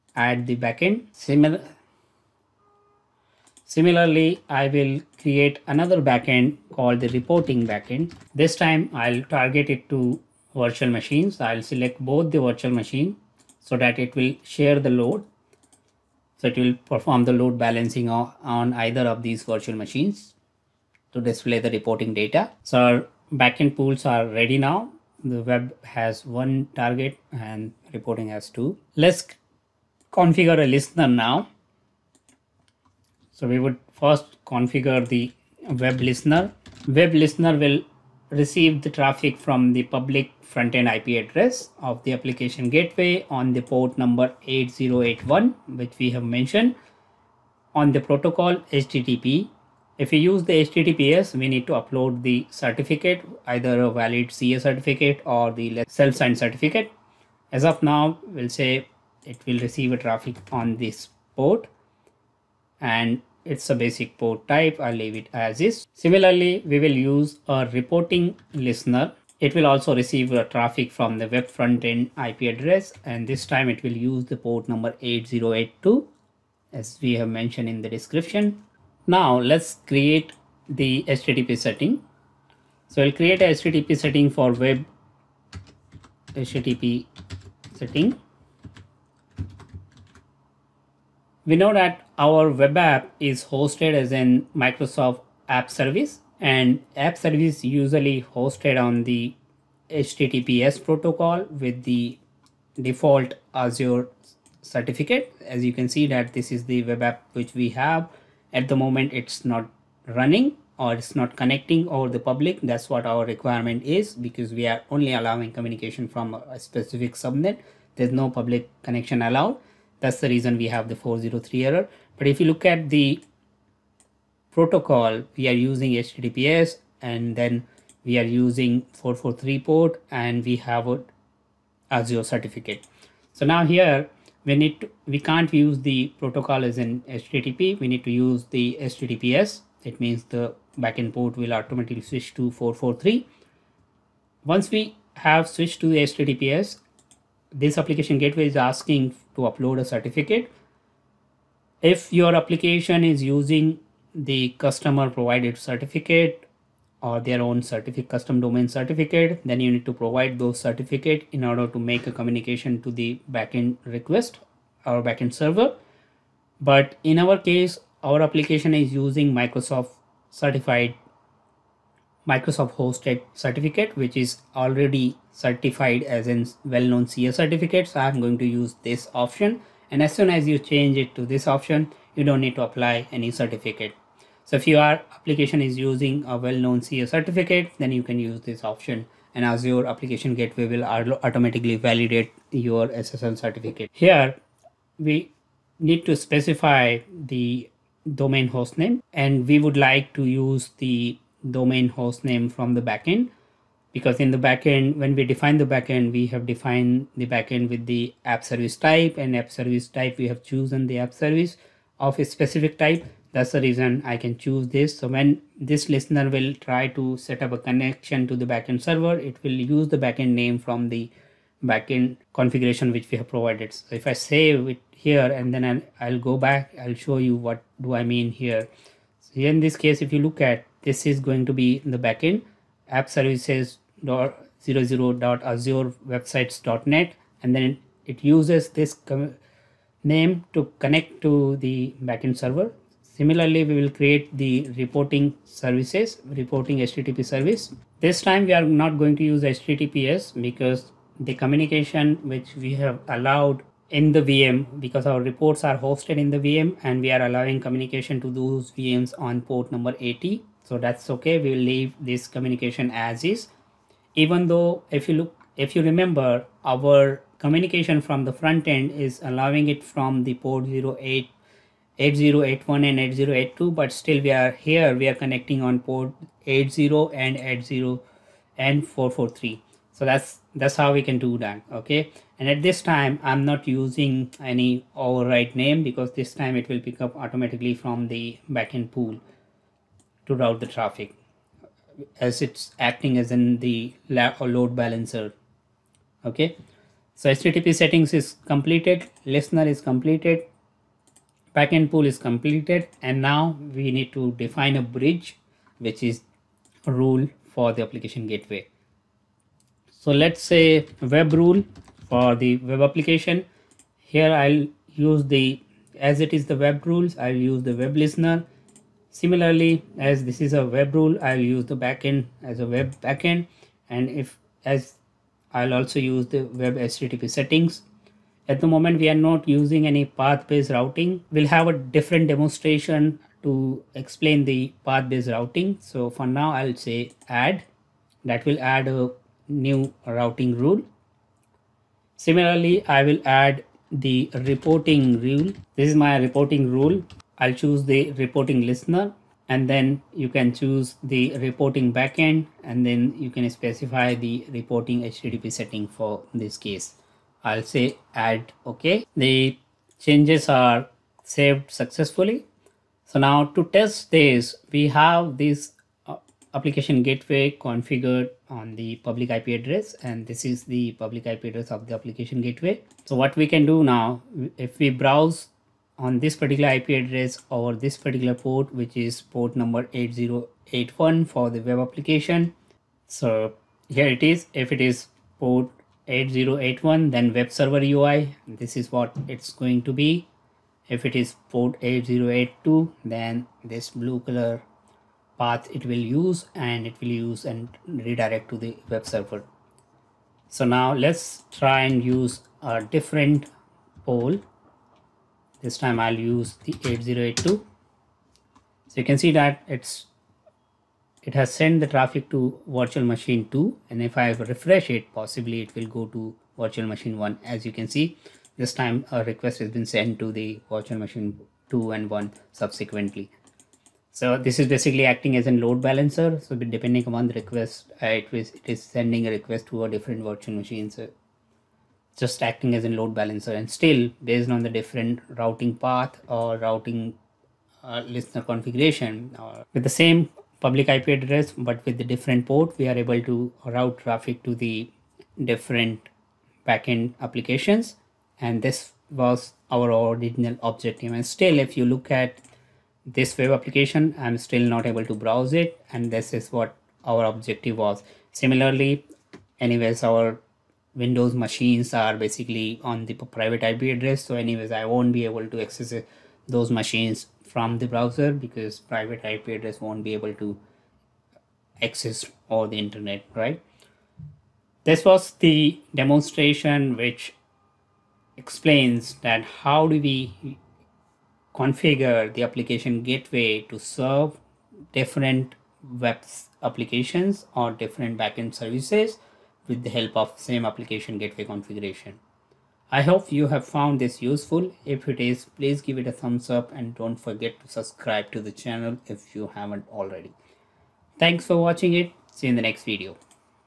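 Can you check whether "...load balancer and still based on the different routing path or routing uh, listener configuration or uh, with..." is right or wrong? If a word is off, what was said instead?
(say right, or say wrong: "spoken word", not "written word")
right.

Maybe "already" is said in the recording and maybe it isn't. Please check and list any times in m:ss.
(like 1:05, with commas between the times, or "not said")
2:54, 8:19.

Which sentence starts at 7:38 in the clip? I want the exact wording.
Similarly, anyways, our Windows machines are basically on the private IP address.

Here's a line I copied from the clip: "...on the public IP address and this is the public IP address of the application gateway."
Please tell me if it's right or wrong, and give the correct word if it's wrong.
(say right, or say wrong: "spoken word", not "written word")
right.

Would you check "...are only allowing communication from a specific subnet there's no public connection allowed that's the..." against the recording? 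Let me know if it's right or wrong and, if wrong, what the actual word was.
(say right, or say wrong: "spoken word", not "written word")
right.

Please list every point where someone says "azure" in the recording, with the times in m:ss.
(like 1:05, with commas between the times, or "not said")
1:43, 2:11, 3:09, 3:55.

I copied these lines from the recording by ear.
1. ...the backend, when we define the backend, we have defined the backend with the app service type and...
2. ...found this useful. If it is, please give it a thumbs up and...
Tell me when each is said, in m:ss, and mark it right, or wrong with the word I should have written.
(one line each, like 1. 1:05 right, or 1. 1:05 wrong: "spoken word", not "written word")
1. 3:24 right
2. 8:13 right.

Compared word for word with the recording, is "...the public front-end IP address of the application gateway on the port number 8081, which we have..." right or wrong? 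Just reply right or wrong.
right.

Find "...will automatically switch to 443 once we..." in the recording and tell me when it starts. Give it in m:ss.
2:21.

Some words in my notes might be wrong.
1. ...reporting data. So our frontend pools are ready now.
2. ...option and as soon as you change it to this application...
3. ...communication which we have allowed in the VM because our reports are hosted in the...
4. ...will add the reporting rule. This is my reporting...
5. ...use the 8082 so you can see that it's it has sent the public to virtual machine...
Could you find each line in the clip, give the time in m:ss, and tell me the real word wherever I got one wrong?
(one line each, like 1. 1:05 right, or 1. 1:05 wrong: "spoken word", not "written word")
1. 0:21 wrong: "backend", not "frontend"
2. 2:59 wrong: "option", not "application"
3. 4:11 right
4. 5:43 right
5. 6:46 wrong: "traffic", not "public".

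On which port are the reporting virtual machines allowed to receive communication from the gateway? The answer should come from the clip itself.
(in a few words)
80.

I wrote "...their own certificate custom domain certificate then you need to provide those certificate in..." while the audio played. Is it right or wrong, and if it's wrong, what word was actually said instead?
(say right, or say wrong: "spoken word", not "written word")
right.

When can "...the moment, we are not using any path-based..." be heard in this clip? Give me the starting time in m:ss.
5:28.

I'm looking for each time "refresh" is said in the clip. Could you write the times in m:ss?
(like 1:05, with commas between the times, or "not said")
6:54.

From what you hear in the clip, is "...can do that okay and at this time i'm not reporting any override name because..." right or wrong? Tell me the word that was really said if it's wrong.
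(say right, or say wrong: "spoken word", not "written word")
wrong: "using", not "reporting".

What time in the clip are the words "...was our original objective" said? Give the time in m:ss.
7:29.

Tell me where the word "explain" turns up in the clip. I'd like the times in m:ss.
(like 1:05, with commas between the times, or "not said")
5:33, 7:58.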